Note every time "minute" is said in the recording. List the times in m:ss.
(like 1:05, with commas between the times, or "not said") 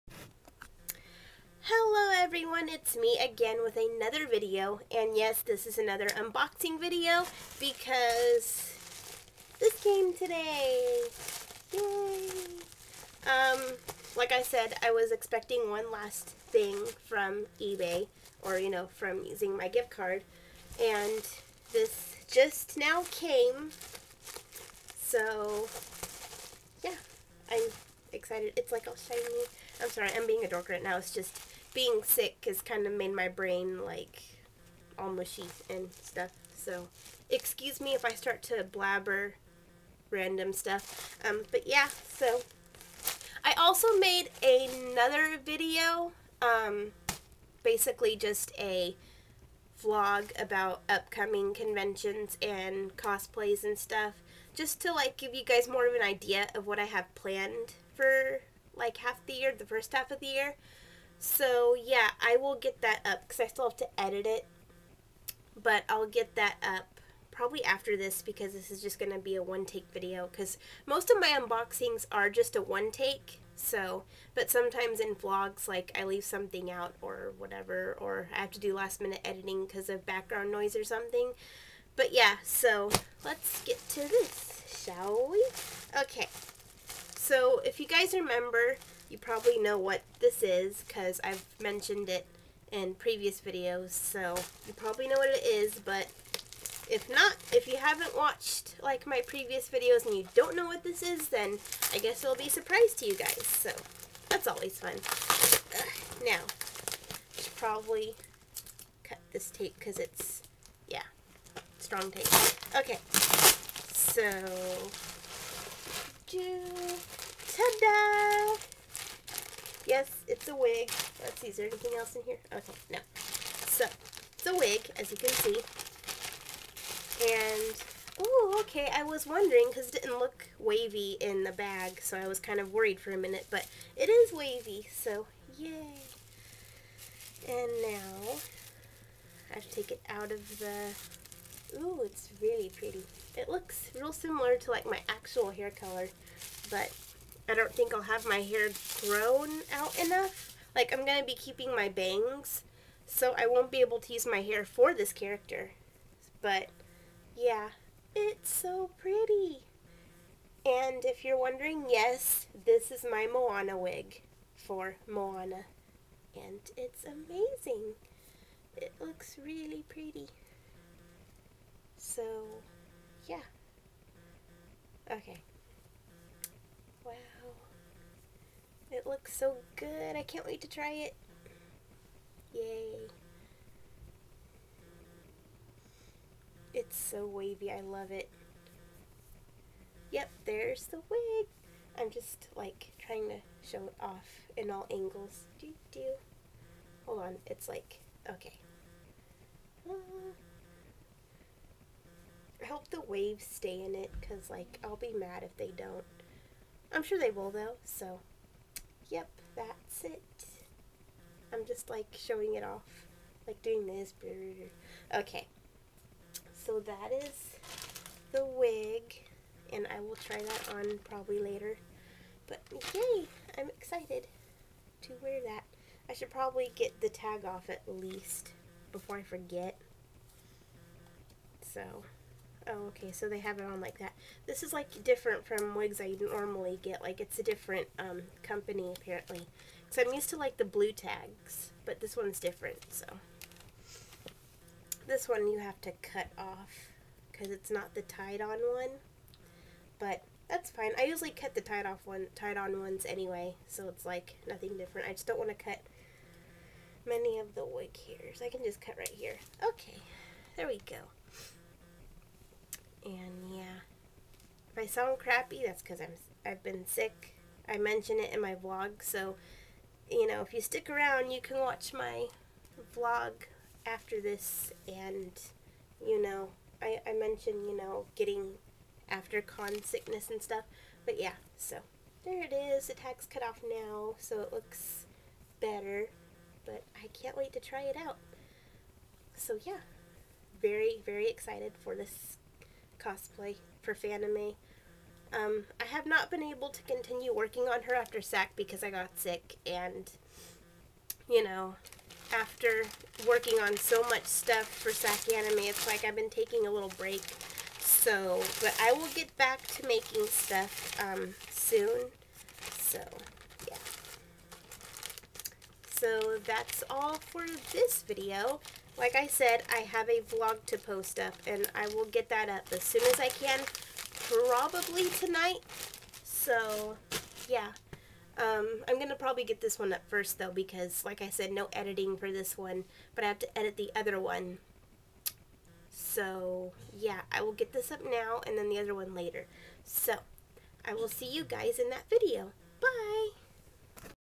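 1:18, 2:13.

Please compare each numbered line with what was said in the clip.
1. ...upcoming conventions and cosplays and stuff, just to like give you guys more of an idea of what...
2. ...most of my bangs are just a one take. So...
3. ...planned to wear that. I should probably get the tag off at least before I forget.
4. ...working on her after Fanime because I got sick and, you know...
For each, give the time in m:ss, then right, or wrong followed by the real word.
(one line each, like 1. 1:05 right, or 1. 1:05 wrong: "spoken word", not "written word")
1. 0:50 right
2. 1:10 wrong: "unboxings", not "bangs"
3. 3:43 wrong: "excited", not "planned"
4. 4:57 wrong: "SAC", not "Fanime".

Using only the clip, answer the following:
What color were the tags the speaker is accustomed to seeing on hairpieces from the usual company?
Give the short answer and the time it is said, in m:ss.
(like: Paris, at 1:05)
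Blue, at 4:00.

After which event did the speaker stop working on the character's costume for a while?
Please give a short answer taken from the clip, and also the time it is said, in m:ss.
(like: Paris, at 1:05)
SAC Anime, at 5:04.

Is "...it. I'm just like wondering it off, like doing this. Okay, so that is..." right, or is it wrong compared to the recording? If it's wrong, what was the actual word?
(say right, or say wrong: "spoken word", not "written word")
wrong: "showing", not "wondering".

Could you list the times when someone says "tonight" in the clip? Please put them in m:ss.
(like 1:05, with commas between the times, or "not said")
5:25.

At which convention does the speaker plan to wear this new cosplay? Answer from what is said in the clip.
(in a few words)
Fanime.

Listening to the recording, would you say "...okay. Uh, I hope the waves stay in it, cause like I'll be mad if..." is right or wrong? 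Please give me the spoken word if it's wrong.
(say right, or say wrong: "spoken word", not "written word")
right.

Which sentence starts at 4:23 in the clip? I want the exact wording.
And yeah, if I sound crappy, that's because I'm I've been sick.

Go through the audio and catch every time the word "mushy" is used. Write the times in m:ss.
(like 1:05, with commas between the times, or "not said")
0:35.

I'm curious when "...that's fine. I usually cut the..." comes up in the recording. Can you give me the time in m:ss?
4:10.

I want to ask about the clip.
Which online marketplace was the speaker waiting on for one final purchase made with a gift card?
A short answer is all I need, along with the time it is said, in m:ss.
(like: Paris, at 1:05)
eBay, at 0:17.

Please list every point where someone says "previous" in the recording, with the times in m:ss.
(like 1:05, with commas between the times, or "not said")
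1:32, 1:39.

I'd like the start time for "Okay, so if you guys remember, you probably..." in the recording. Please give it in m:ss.
1:26.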